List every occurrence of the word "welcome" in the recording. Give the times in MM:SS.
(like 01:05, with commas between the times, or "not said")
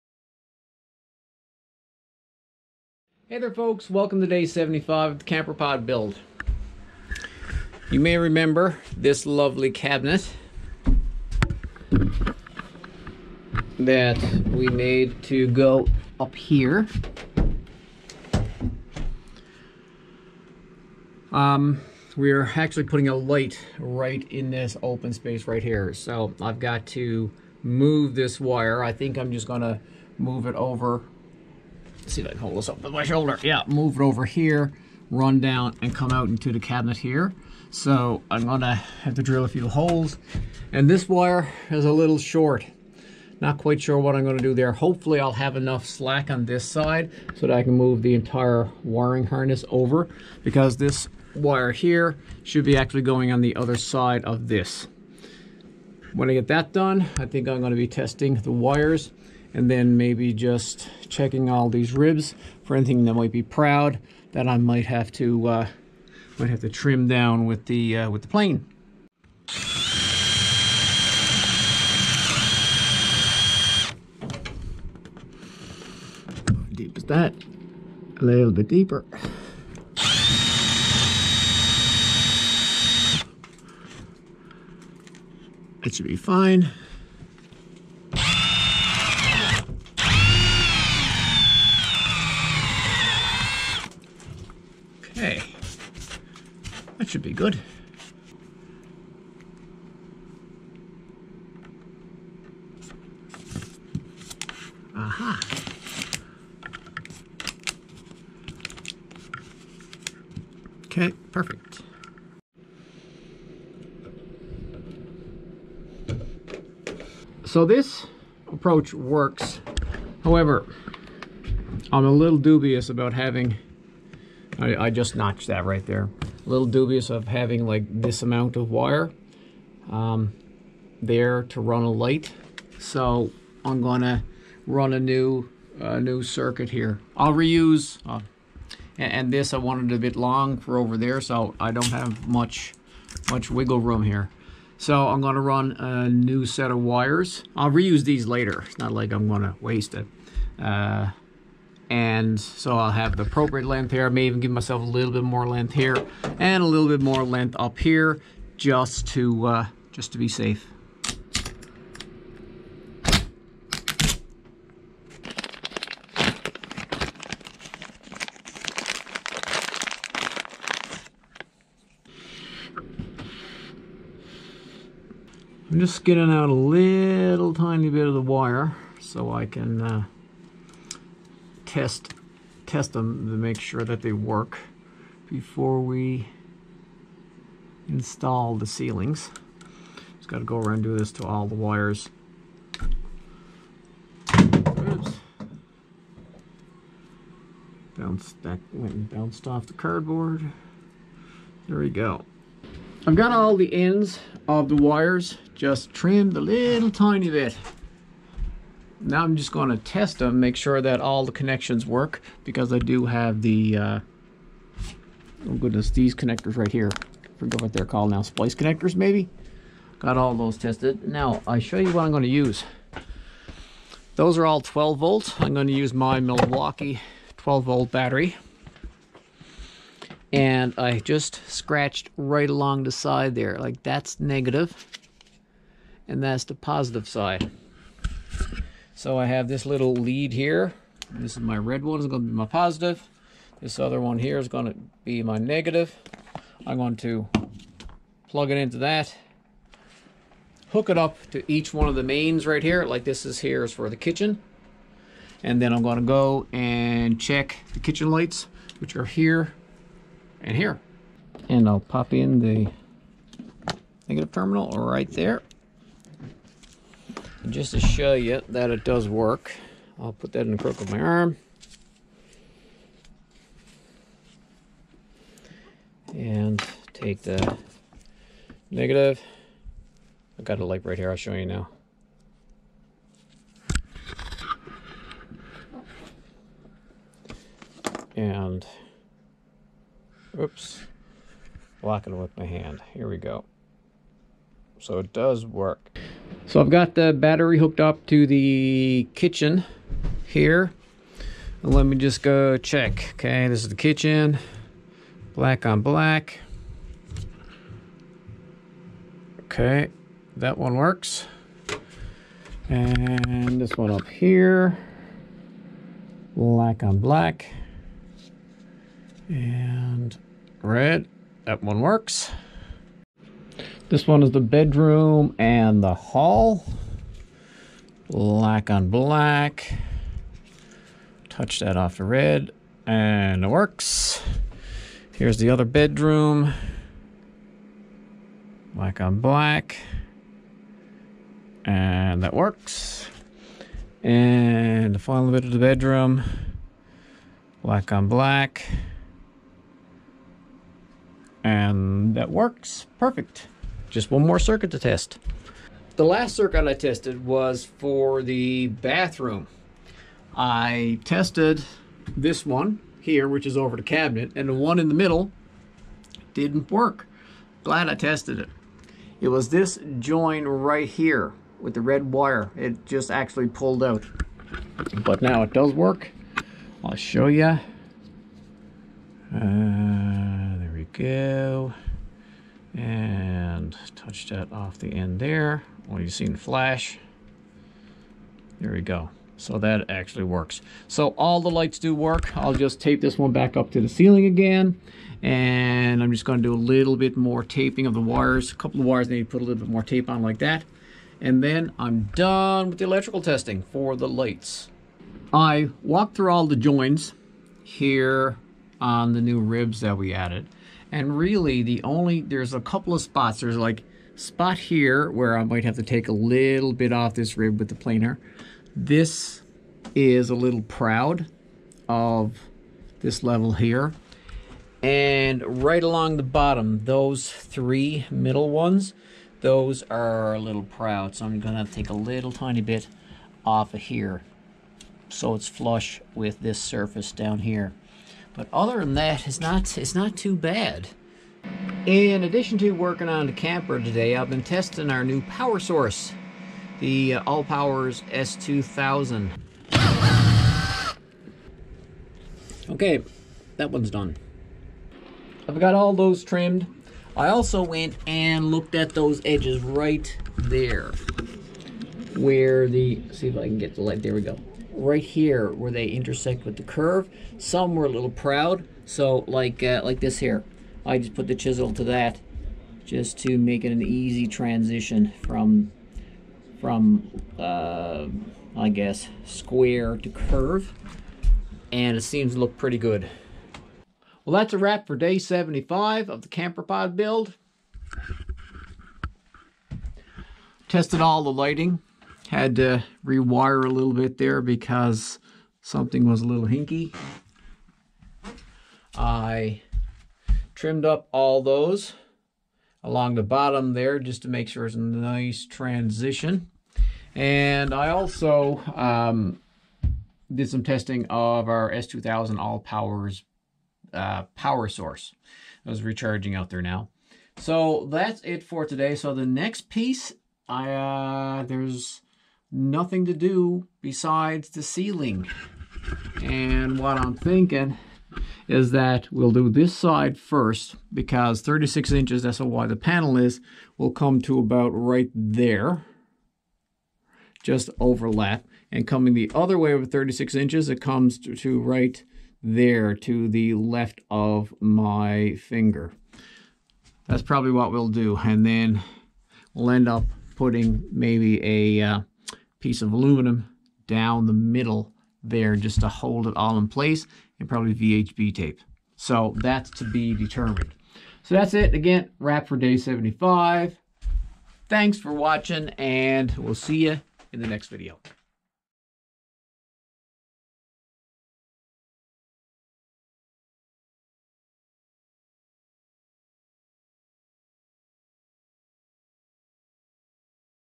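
00:03.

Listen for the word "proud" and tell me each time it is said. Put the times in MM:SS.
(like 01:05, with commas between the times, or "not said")
01:03, 07:00, 07:10, 07:48.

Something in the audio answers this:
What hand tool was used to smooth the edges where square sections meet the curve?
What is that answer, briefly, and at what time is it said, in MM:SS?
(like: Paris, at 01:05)
chisel, at 07:51.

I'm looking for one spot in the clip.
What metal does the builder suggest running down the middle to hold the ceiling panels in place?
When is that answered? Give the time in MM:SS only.
09:12.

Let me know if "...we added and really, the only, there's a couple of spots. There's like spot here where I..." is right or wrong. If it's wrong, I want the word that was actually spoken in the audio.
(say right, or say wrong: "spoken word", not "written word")
right.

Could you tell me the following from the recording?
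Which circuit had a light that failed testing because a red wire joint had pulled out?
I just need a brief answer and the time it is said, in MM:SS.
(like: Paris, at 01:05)
bathroom, at 05:58.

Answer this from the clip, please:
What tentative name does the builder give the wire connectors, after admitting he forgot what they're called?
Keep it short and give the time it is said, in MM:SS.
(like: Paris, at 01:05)
splice connectors, at 03:38.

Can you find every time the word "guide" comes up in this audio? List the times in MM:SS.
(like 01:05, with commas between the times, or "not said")
not said.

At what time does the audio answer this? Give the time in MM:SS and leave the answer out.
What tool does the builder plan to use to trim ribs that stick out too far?
01:08.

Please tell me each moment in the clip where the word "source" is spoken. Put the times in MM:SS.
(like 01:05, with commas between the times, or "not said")
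07:25, 08:34.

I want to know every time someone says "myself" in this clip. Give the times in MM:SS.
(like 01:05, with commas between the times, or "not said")
02:34.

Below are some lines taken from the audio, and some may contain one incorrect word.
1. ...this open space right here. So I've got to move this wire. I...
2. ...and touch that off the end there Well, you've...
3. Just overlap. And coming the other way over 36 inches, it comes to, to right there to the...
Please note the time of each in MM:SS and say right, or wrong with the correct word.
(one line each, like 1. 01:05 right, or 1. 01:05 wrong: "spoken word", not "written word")
1. 00:24 right
2. 06:22 right
3. 08:57 right.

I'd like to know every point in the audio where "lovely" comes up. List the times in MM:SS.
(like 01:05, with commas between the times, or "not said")
00:09.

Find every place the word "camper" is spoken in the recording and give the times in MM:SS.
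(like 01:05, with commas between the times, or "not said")
00:05, 07:23, 08:06.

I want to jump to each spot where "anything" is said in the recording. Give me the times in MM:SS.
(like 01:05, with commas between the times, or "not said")
01:02.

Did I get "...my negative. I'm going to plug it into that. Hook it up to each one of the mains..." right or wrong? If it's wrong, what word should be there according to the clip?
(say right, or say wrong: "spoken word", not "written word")
right.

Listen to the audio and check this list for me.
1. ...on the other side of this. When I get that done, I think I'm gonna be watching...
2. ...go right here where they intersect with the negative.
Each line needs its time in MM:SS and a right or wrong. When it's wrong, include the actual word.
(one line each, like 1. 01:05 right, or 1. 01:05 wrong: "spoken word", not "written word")
1. 00:53 wrong: "testing", not "watching"
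2. 07:44 wrong: "curve", not "negative".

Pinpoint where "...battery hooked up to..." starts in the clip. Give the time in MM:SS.
04:57.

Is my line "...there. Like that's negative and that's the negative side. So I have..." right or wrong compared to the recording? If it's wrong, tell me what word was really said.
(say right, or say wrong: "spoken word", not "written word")
wrong: "positive", not "negative".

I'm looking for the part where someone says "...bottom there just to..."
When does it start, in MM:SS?
08:23.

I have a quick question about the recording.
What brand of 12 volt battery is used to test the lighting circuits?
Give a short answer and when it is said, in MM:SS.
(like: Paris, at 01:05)
Milwaukee, at 03:46.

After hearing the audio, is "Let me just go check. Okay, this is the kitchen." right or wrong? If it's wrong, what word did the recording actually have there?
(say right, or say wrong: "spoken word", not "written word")
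right.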